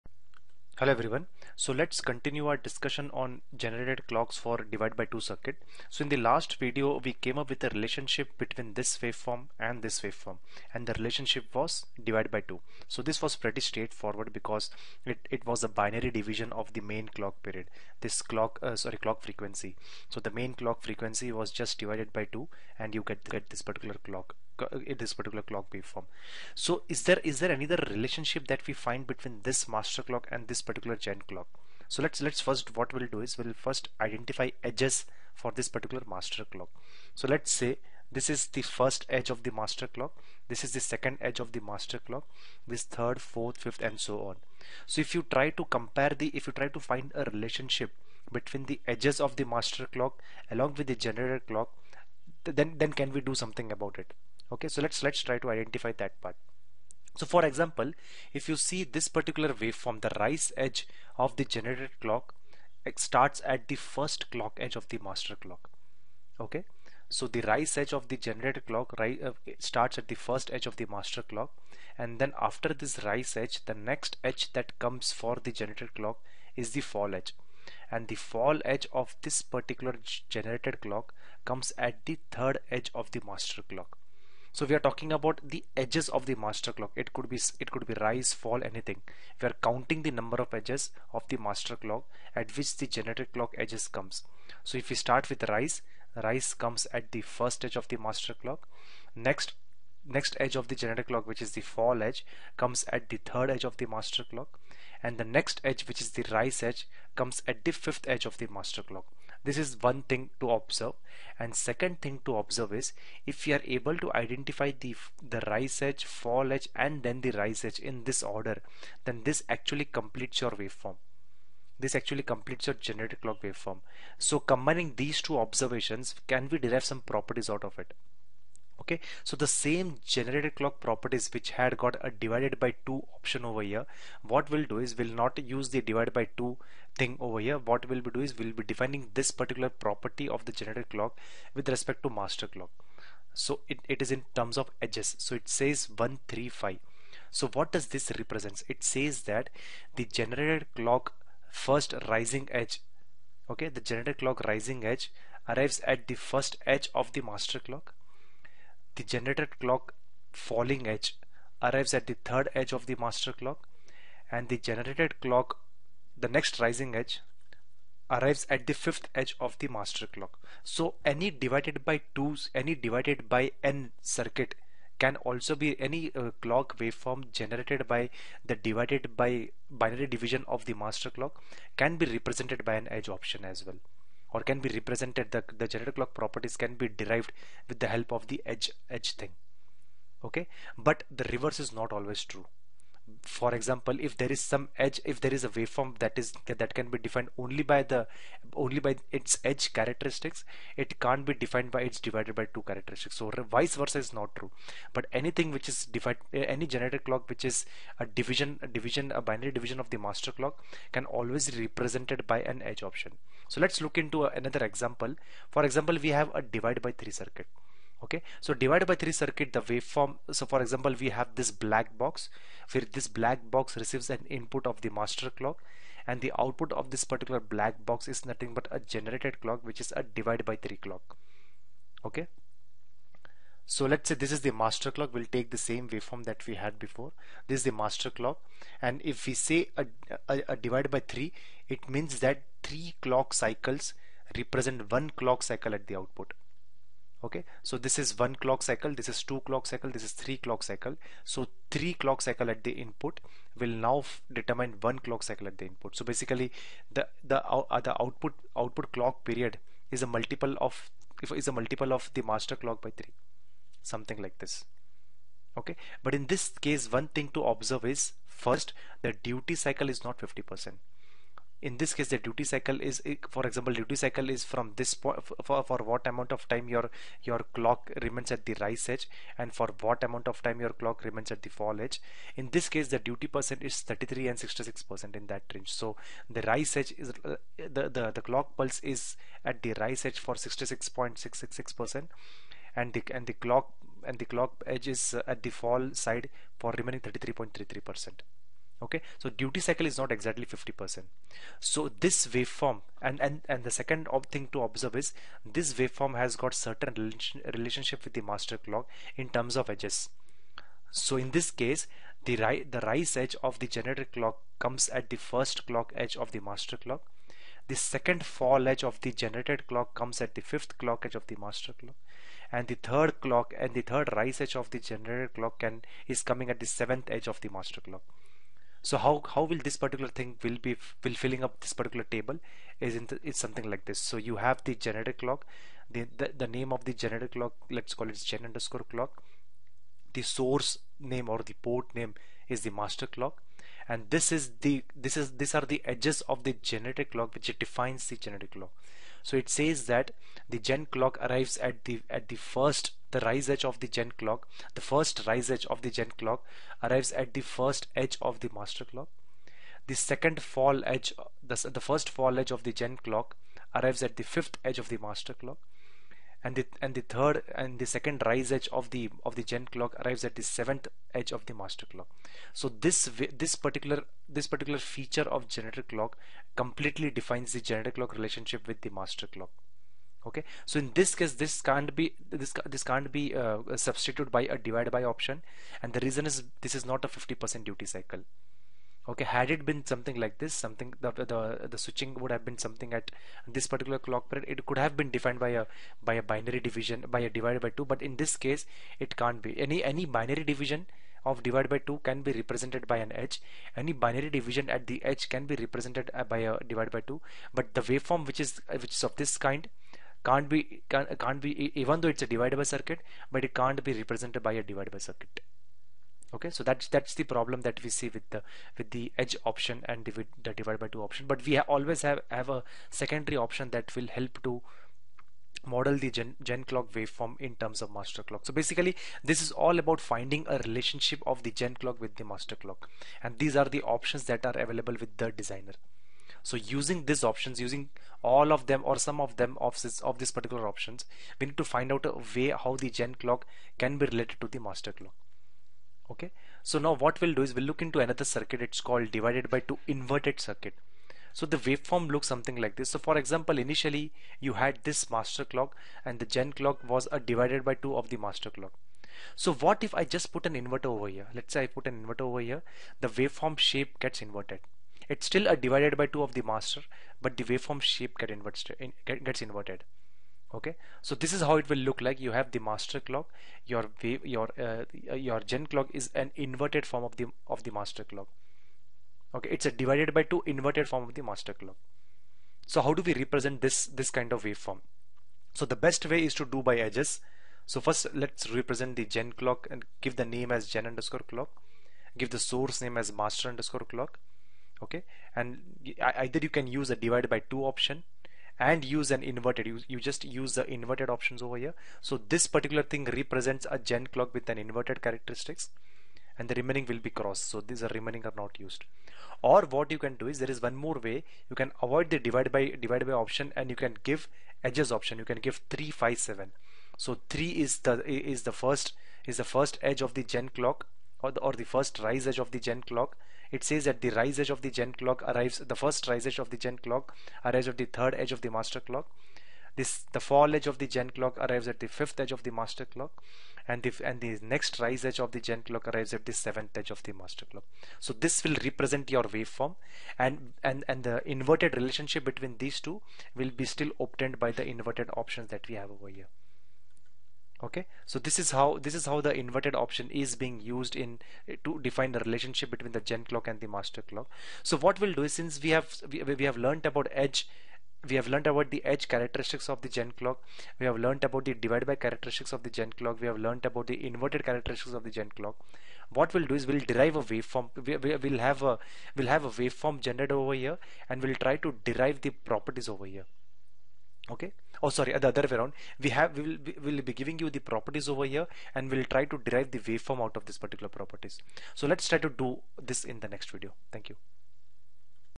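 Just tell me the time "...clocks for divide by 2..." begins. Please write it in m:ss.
0:04.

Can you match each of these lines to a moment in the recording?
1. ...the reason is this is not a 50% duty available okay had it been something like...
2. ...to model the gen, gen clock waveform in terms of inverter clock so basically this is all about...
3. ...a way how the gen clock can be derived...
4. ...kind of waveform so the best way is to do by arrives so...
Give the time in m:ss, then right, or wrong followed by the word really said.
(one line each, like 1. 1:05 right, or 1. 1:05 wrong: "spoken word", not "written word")
1. 6:25 wrong: "cycle", not "available"
2. 7:04 wrong: "master", not "inverter"
3. 7:22 wrong: "related", not "derived"
4. 8:04 wrong: "edges", not "arrives".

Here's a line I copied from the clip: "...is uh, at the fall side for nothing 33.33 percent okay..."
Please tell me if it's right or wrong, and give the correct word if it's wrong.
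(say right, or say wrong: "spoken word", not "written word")
wrong: "remaining", not "nothing".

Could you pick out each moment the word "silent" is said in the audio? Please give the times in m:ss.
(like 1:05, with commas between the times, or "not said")
not said.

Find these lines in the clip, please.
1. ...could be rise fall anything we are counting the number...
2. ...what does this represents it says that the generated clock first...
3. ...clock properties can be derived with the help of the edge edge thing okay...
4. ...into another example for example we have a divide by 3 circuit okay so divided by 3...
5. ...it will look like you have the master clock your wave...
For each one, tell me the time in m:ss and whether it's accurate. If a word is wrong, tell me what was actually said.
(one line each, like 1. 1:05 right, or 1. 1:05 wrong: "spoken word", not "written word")
1. 1:27 right
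2. 2:27 right
3. 3:05 right
4. 3:34 right
5. 7:51 right.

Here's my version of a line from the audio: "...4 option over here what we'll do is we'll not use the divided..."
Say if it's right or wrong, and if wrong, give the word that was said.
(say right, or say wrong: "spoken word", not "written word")
wrong: "2", not "4".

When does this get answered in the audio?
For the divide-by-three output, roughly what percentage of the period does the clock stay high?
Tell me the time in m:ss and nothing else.
4:50.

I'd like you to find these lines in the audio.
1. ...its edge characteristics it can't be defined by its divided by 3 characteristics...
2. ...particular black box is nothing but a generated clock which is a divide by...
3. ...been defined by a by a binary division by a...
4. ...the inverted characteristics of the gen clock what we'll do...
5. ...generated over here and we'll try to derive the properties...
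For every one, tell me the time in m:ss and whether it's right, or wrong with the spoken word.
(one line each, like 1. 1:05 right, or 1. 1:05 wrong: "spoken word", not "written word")
1. 3:19 wrong: "2", not "3"
2. 3:47 right
3. 6:34 right
4. 9:23 right
5. 9:29 right.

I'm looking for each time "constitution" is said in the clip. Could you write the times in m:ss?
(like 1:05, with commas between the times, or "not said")
not said.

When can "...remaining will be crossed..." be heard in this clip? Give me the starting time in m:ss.
8:26.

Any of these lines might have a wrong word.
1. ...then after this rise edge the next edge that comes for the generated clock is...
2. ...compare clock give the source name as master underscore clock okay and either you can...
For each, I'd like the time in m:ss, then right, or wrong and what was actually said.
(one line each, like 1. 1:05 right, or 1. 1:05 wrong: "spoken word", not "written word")
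1. 1:12 right
2. 8:10 wrong: "underscore", not "compare".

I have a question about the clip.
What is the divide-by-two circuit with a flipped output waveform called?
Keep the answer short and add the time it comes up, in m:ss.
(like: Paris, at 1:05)
divided by 2 inverted circuit, at 7:29.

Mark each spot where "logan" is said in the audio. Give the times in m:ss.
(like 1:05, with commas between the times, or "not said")
not said.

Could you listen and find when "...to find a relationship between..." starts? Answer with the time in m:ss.
0:46.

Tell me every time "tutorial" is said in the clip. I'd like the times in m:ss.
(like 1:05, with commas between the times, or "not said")
not said.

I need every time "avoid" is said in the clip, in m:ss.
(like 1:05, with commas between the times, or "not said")
8:31.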